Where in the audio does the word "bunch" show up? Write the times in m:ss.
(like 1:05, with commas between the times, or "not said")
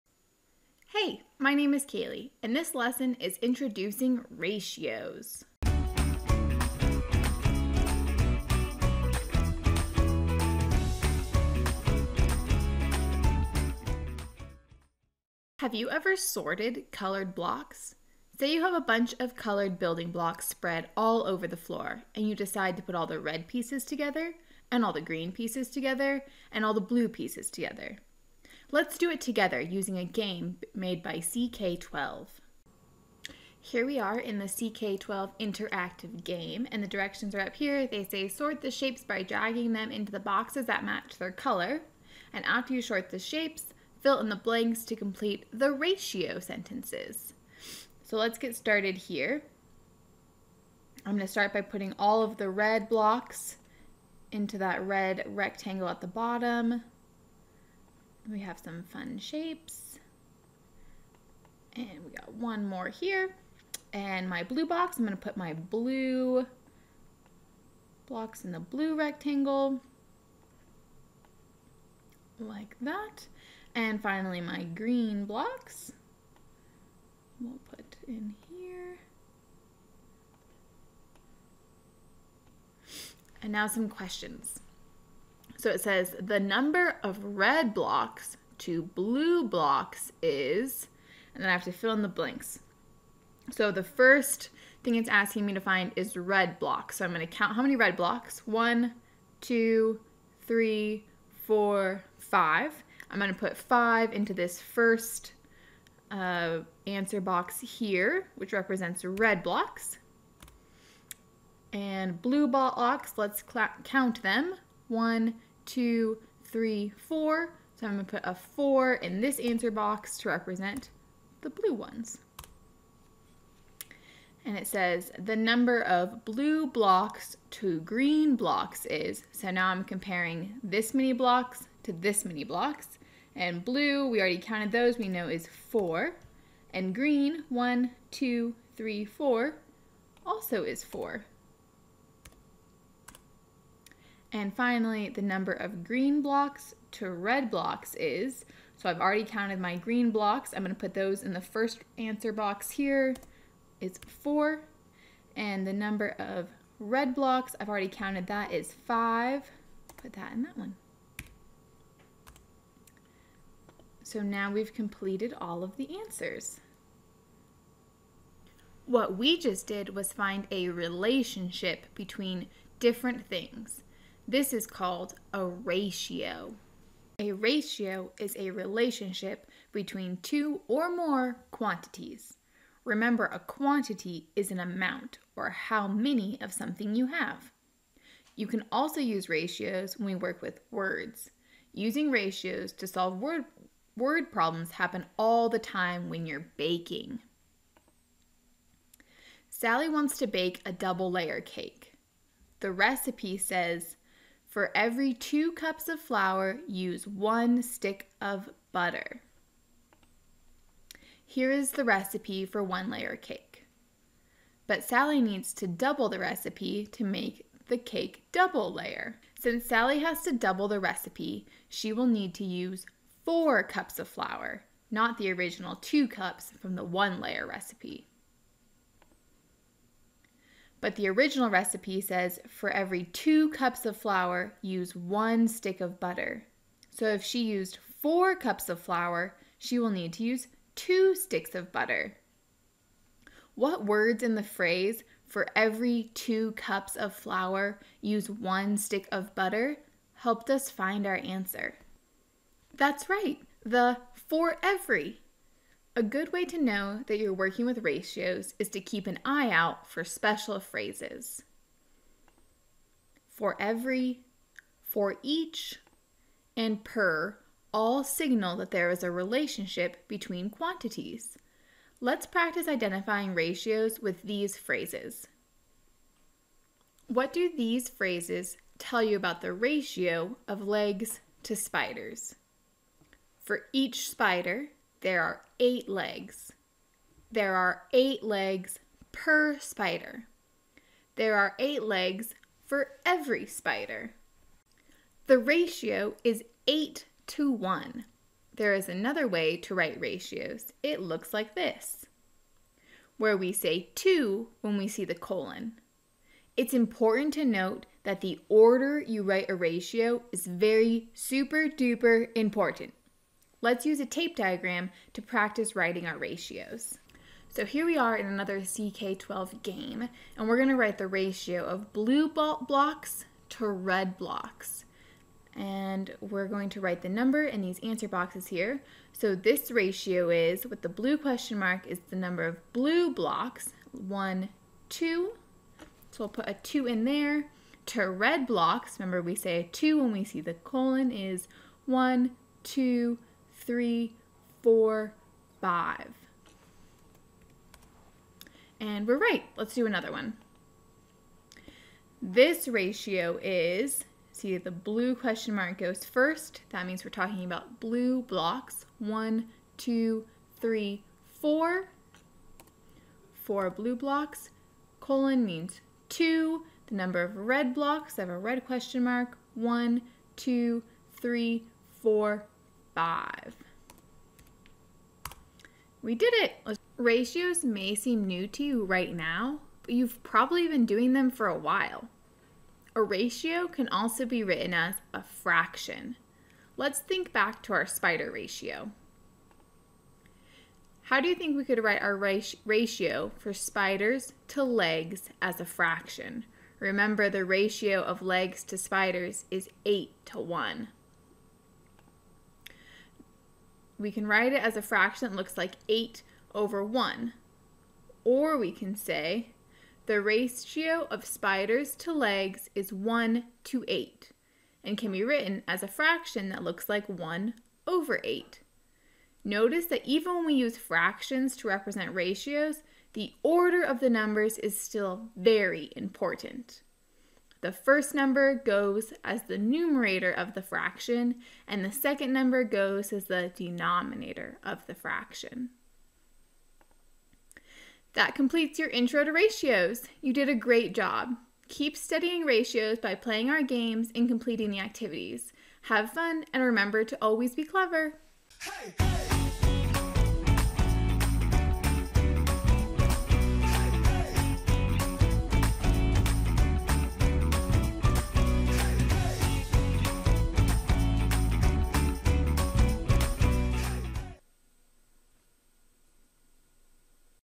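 0:18.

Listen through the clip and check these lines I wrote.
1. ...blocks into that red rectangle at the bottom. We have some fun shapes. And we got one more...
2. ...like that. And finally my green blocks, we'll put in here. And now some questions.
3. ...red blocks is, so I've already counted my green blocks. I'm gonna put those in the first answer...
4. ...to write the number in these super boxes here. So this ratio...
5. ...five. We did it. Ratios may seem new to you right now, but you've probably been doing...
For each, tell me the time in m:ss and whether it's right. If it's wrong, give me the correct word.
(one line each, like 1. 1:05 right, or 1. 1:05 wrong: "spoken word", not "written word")
1. 0:52 right
2. 1:12 right
3. 2:27 right
4. 5:26 wrong: "answer", not "super"
5. 6:12 right.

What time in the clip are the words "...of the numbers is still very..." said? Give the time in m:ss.
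7:03.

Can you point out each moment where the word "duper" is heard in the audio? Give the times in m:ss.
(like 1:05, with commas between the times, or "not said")
5:11.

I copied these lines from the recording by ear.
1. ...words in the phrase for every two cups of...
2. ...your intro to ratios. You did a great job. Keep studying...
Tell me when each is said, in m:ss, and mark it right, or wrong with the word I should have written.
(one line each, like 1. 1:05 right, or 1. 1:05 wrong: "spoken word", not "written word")
1. 4:03 right
2. 7:18 right.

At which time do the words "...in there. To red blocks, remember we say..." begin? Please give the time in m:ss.
5:36.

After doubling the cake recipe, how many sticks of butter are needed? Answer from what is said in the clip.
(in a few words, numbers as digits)
2.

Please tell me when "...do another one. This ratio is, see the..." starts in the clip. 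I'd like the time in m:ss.
5:49.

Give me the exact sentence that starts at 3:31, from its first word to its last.
Here is the recipe for one layer cake.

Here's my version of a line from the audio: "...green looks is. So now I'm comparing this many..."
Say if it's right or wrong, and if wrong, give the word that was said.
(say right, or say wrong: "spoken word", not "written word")
wrong: "blocks", not "looks".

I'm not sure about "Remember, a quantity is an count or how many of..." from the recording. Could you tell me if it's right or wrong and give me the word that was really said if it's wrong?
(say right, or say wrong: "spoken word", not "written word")
wrong: "amount", not "count".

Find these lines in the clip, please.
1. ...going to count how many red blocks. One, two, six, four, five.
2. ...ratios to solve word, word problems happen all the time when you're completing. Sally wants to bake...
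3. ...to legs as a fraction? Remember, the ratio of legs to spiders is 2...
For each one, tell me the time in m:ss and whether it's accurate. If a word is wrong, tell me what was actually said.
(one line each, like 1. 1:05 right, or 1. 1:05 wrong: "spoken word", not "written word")
1. 1:37 wrong: "three", not "six"
2. 3:12 wrong: "baking", not "completing"
3. 6:34 wrong: "8", not "2".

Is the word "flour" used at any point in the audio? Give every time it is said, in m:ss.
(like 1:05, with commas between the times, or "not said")
3:26, 3:44, 3:53, 3:58, 4:07.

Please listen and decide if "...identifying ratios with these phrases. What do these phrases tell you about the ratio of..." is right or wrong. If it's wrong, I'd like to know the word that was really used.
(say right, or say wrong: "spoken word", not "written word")
right.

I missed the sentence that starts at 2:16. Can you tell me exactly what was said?
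And green, one, two, three, four, also is 4.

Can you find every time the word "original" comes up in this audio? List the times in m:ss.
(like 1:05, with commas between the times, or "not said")
3:45, 3:51.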